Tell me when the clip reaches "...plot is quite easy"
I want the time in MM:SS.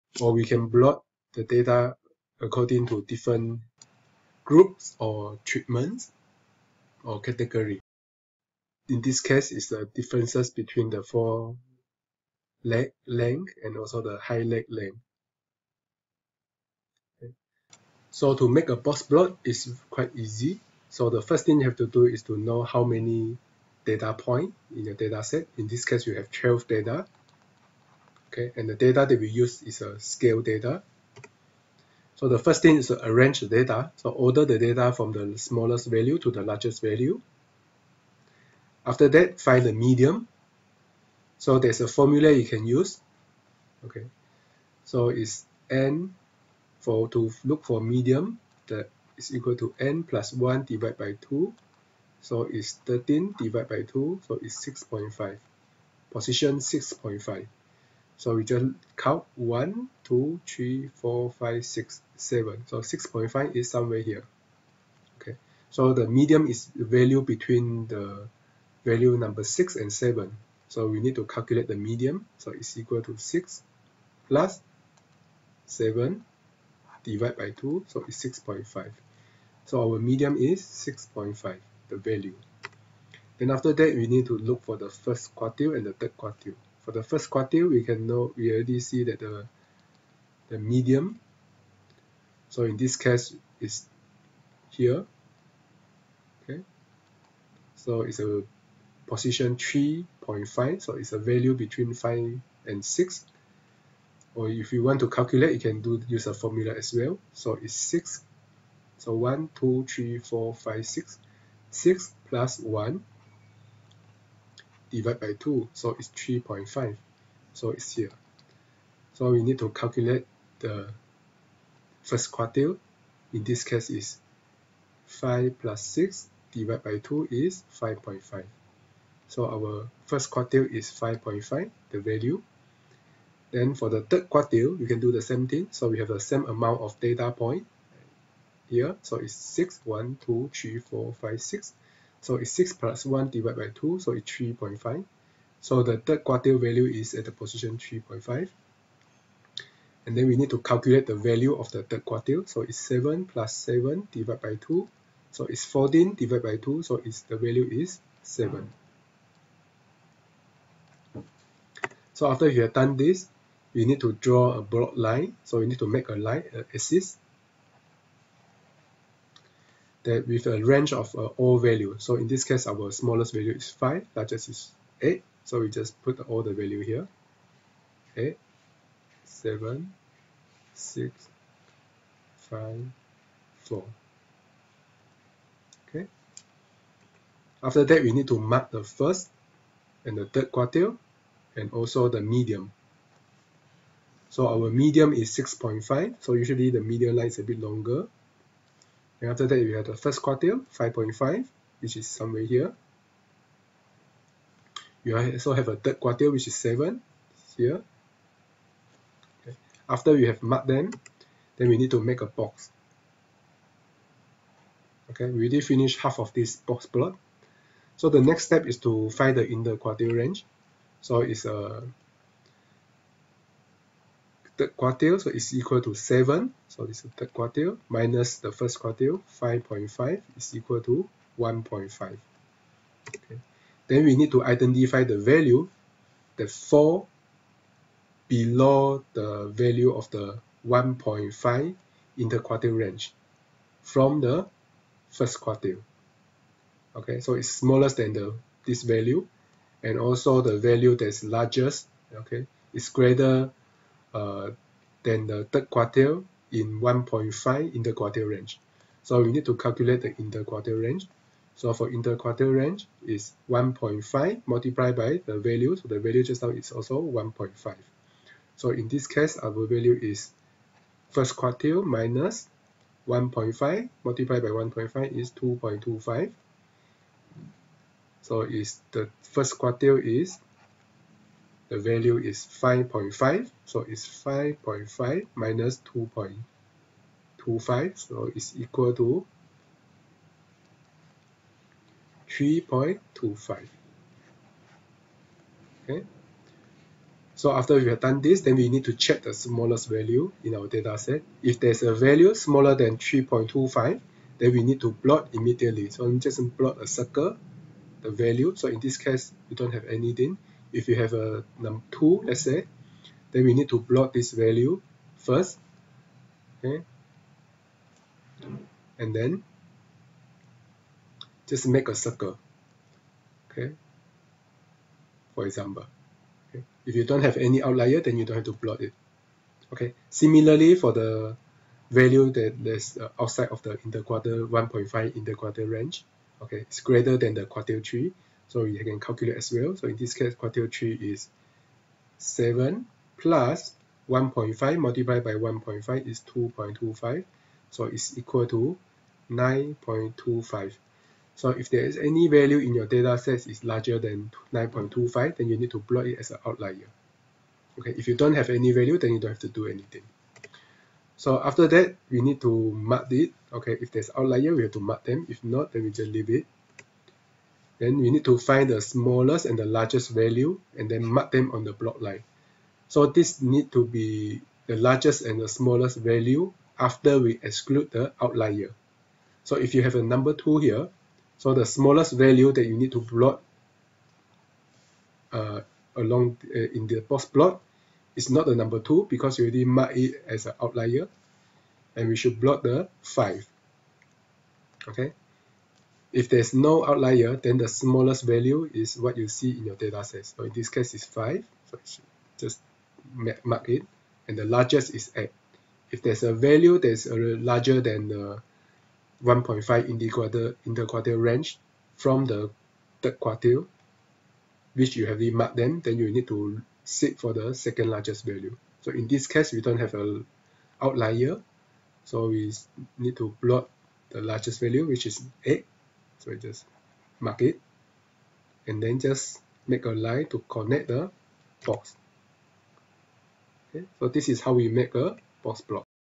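00:19.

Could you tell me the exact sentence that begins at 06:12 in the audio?
So this need to be the largest and the smallest value after we exclude the outlier.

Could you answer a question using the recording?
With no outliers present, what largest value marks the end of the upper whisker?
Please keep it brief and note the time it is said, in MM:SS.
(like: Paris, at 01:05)
8, at 07:04.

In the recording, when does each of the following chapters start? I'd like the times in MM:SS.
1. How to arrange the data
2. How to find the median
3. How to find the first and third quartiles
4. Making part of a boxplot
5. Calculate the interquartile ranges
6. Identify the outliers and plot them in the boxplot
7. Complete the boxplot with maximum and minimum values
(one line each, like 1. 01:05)
1. 00:26
2. 00:46
3. 01:24
4. 02:44
5. 03:38
6. 04:56
7. 06:06.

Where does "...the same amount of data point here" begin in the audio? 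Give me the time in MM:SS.
02:16.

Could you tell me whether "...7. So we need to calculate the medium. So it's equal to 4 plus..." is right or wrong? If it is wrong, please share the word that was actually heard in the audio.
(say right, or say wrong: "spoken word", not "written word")
wrong: "6", not "4".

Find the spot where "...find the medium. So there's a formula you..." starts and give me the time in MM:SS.
00:39.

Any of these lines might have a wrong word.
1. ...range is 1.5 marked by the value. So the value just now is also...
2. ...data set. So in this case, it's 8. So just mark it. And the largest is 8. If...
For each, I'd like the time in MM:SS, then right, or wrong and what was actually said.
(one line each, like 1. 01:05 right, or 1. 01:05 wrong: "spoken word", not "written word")
1. 04:22 wrong: "multiplied", not "marked"
2. 06:39 wrong: "5", not "8".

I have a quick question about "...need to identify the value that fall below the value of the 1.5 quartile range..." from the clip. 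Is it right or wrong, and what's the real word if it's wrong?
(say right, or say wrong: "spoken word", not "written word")
wrong: "interquartile", not "quartile".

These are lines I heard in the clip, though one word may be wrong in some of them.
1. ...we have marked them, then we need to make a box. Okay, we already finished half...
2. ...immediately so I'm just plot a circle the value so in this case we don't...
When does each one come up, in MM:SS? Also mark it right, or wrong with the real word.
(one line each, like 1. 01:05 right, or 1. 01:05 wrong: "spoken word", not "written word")
1. 03:30 right
2. 05:05 right.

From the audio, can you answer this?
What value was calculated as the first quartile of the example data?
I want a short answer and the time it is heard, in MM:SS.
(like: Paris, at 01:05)
5.5, at 02:10.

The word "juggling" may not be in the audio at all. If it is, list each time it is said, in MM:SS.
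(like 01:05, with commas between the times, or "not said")
not said.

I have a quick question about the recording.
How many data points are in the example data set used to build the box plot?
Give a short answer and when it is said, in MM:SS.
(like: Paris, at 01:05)
12, at 00:26.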